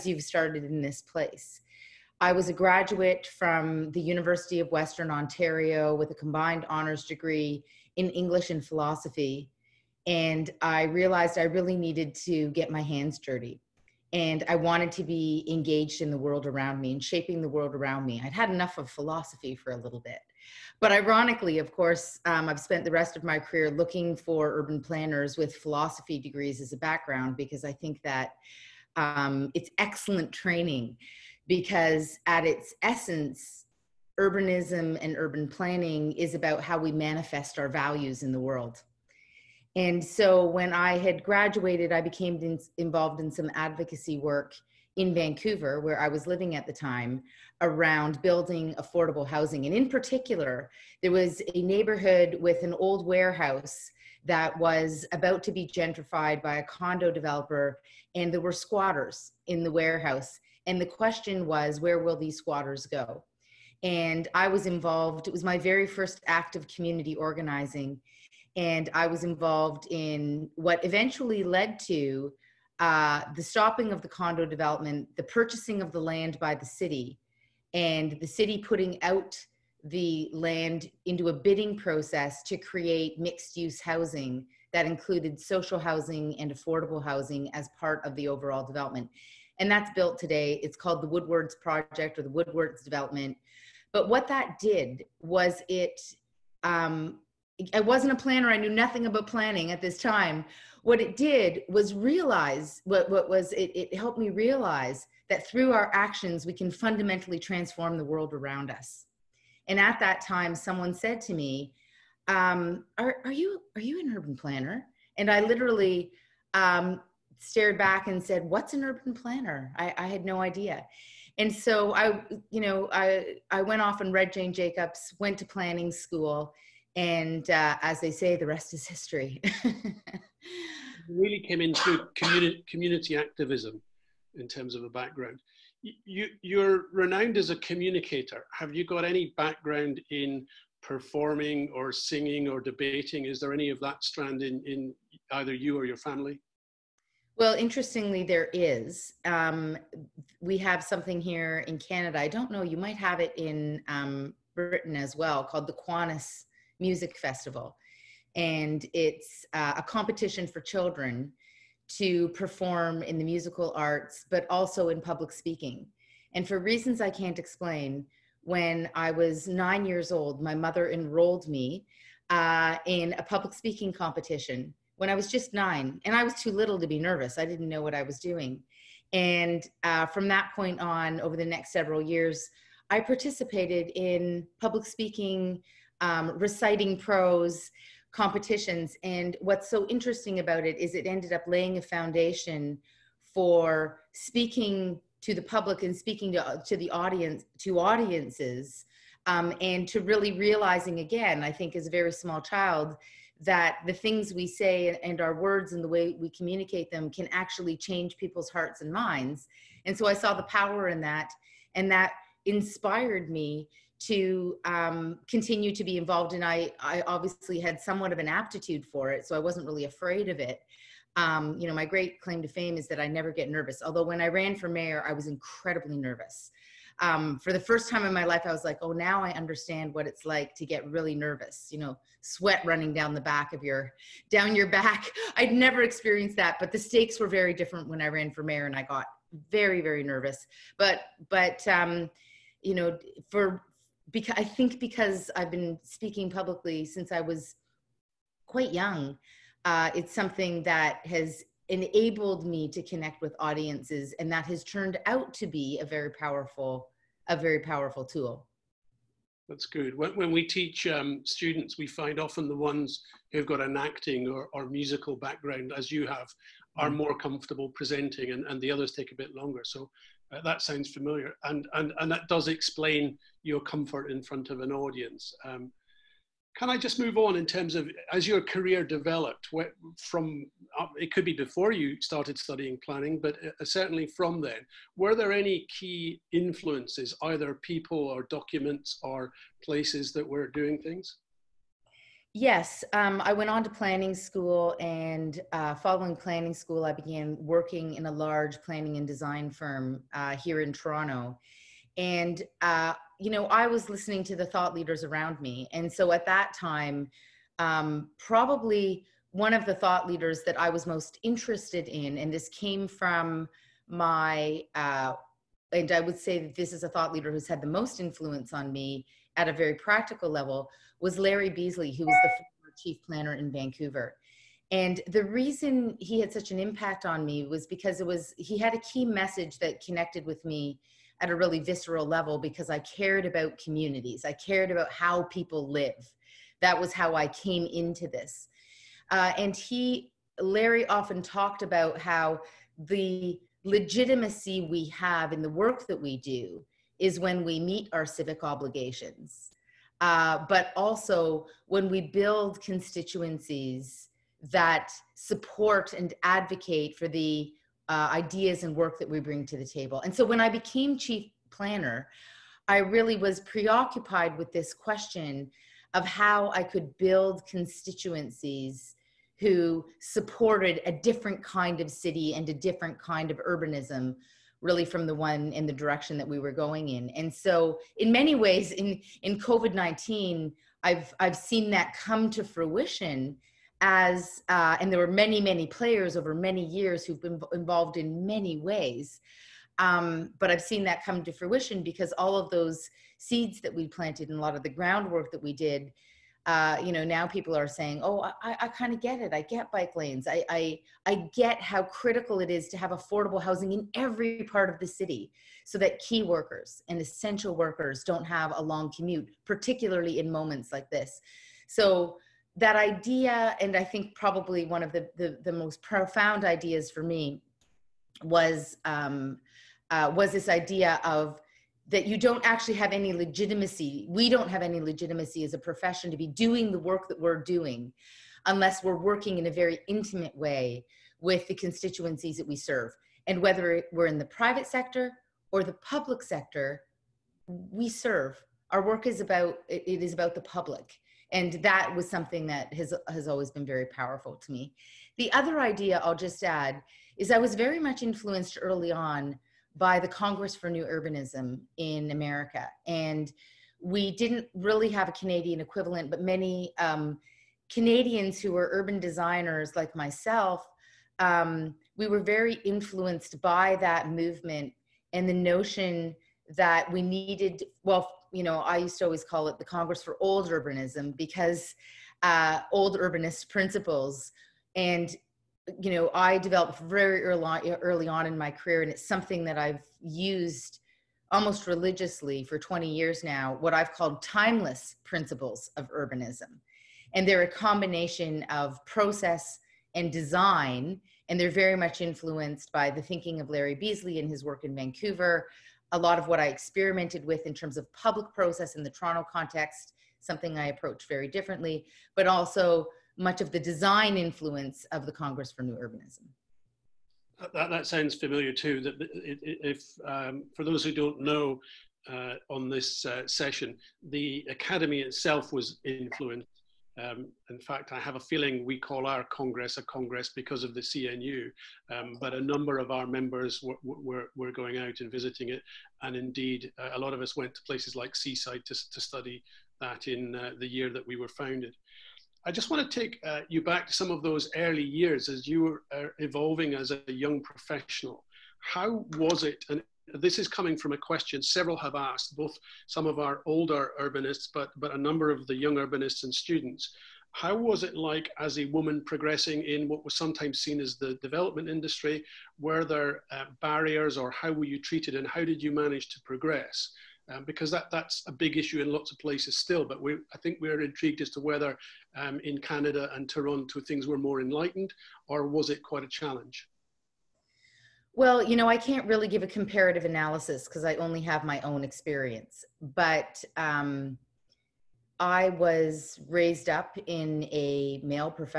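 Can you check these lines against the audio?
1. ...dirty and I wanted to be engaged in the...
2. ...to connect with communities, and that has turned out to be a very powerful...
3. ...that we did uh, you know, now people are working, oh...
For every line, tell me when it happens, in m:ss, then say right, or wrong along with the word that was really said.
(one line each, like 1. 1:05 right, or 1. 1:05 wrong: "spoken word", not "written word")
1. 0:13 right
2. 4:12 wrong: "audiences", not "communities"
3. 6:35 wrong: "saying", not "working".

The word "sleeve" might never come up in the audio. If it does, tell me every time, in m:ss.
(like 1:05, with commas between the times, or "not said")
not said.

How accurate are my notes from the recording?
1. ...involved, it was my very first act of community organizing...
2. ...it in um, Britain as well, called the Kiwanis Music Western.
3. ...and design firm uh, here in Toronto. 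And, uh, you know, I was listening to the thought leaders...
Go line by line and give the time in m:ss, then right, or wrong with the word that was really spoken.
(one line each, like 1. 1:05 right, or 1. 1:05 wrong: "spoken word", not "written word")
1. 1:04 right
2. 2:33 wrong: "Festival", not "Western"
3. 4:58 right.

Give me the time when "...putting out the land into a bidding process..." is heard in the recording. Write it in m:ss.
1:18.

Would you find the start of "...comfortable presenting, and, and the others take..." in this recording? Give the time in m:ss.
4:27.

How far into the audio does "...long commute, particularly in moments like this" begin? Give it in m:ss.
6:48.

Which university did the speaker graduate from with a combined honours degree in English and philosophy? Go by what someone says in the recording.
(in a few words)
University of Western Ontario.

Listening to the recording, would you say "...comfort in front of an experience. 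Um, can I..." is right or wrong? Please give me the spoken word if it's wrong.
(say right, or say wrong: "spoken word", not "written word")
wrong: "audience", not "experience".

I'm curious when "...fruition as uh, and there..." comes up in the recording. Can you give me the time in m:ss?
6:22.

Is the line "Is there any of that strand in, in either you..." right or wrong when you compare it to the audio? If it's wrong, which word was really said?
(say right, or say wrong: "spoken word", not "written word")
right.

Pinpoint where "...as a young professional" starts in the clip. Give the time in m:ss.
8:56.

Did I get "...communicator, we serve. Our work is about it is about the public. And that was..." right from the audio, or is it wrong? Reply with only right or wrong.
wrong.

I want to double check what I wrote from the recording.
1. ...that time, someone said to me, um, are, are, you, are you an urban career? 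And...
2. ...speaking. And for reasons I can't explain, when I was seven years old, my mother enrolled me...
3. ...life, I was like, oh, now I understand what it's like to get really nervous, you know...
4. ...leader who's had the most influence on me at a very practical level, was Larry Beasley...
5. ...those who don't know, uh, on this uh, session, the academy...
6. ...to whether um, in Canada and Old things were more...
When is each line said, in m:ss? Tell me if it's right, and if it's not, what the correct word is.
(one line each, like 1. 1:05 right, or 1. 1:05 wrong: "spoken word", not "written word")
1. 1:50 wrong: "planner", not "career"
2. 2:45 wrong: "nine", not "seven"
3. 3:48 right
4. 5:17 right
5. 8:30 right
6. 9:21 wrong: "Toronto", not "Old".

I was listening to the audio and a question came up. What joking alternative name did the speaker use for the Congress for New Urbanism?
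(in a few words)
Congress for Old Urbanism.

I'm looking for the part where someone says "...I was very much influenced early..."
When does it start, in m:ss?
7:27.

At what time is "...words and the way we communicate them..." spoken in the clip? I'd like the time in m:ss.
3:25.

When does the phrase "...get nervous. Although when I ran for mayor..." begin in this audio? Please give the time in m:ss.
3:43.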